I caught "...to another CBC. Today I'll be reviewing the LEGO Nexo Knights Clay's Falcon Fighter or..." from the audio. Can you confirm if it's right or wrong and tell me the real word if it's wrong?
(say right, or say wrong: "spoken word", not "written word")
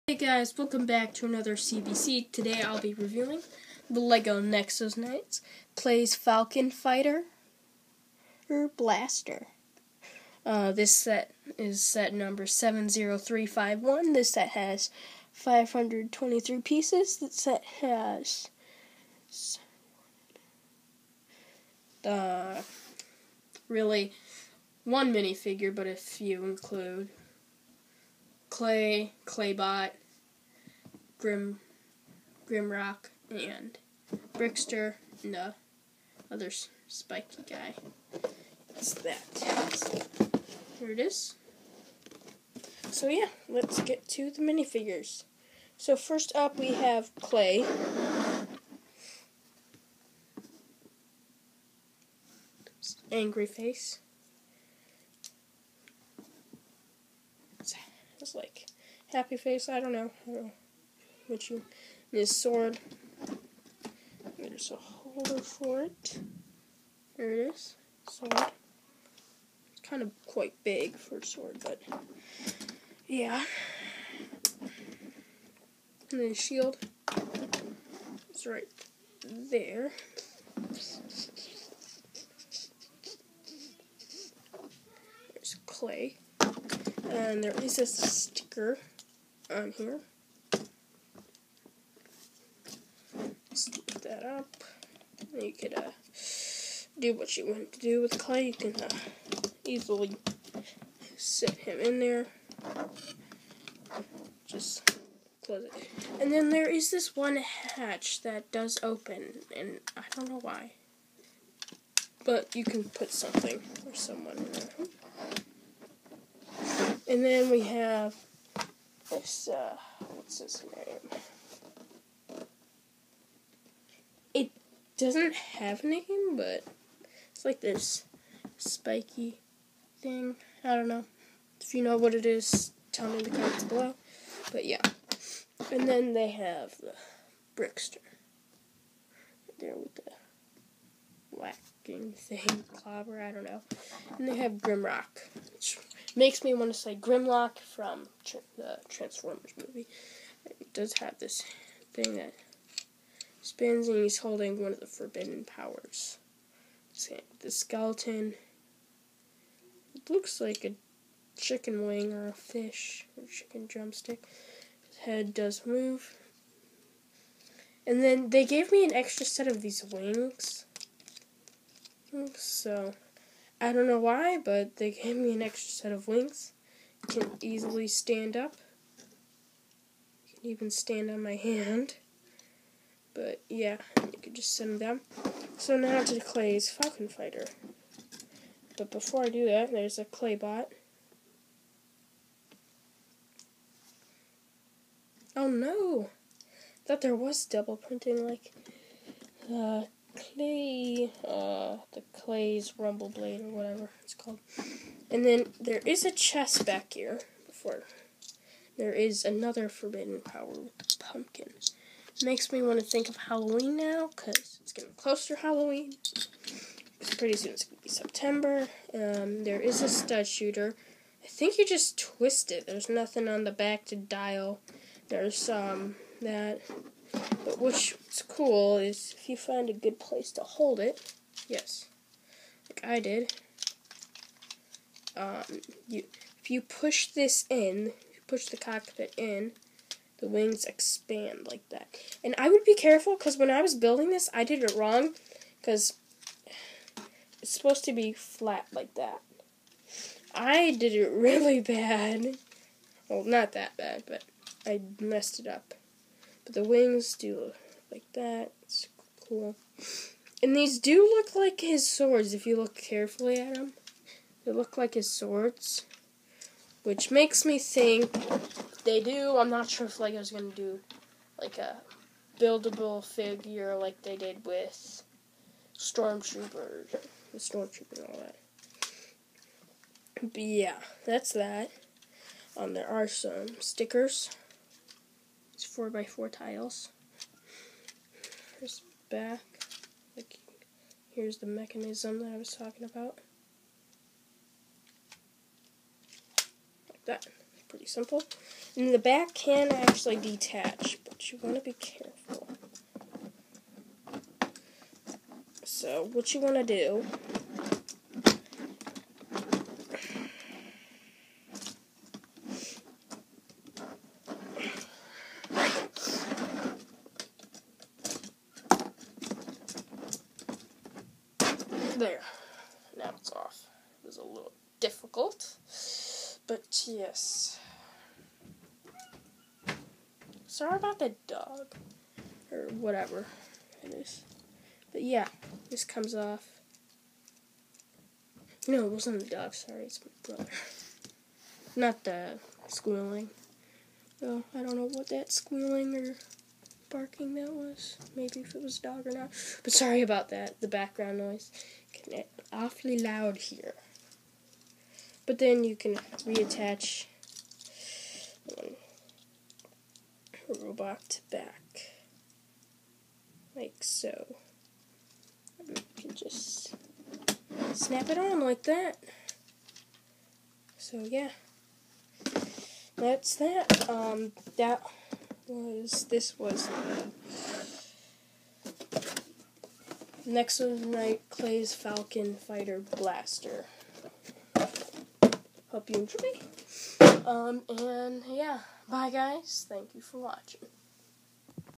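right.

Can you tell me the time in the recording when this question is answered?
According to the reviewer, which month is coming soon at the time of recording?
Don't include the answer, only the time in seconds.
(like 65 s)
217 s.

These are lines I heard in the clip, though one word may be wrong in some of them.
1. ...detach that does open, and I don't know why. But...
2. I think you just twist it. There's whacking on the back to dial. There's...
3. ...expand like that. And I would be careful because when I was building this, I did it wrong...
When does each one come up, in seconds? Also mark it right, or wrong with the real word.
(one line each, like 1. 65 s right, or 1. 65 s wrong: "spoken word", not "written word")
1. 107 s wrong: "hatch", not "detach"
2. 221 s wrong: "nothing", not "whacking"
3. 240 s right.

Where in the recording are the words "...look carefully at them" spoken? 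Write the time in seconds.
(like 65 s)
262 s.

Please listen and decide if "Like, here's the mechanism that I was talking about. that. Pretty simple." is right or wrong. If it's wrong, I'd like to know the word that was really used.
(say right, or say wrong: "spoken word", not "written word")
right.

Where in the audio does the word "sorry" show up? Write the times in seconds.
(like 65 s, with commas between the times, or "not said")
330 s, 339 s, 349 s.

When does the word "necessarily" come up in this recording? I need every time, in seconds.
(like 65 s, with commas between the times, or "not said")
not said.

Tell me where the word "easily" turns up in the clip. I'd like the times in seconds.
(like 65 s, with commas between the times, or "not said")
99 s, 177 s.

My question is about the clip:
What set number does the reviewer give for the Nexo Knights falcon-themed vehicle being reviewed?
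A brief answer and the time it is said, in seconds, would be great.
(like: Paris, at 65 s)
70351, at 12 s.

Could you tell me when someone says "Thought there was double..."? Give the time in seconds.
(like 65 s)
196 s.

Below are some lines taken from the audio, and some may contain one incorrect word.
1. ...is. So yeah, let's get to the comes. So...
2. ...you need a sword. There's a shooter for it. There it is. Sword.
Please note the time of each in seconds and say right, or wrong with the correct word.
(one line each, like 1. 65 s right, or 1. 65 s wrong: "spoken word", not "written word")
1. 40 s wrong: "minifigures", not "comes"
2. 61 s wrong: "holder", not "shooter".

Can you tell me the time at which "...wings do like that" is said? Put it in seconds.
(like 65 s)
256 s.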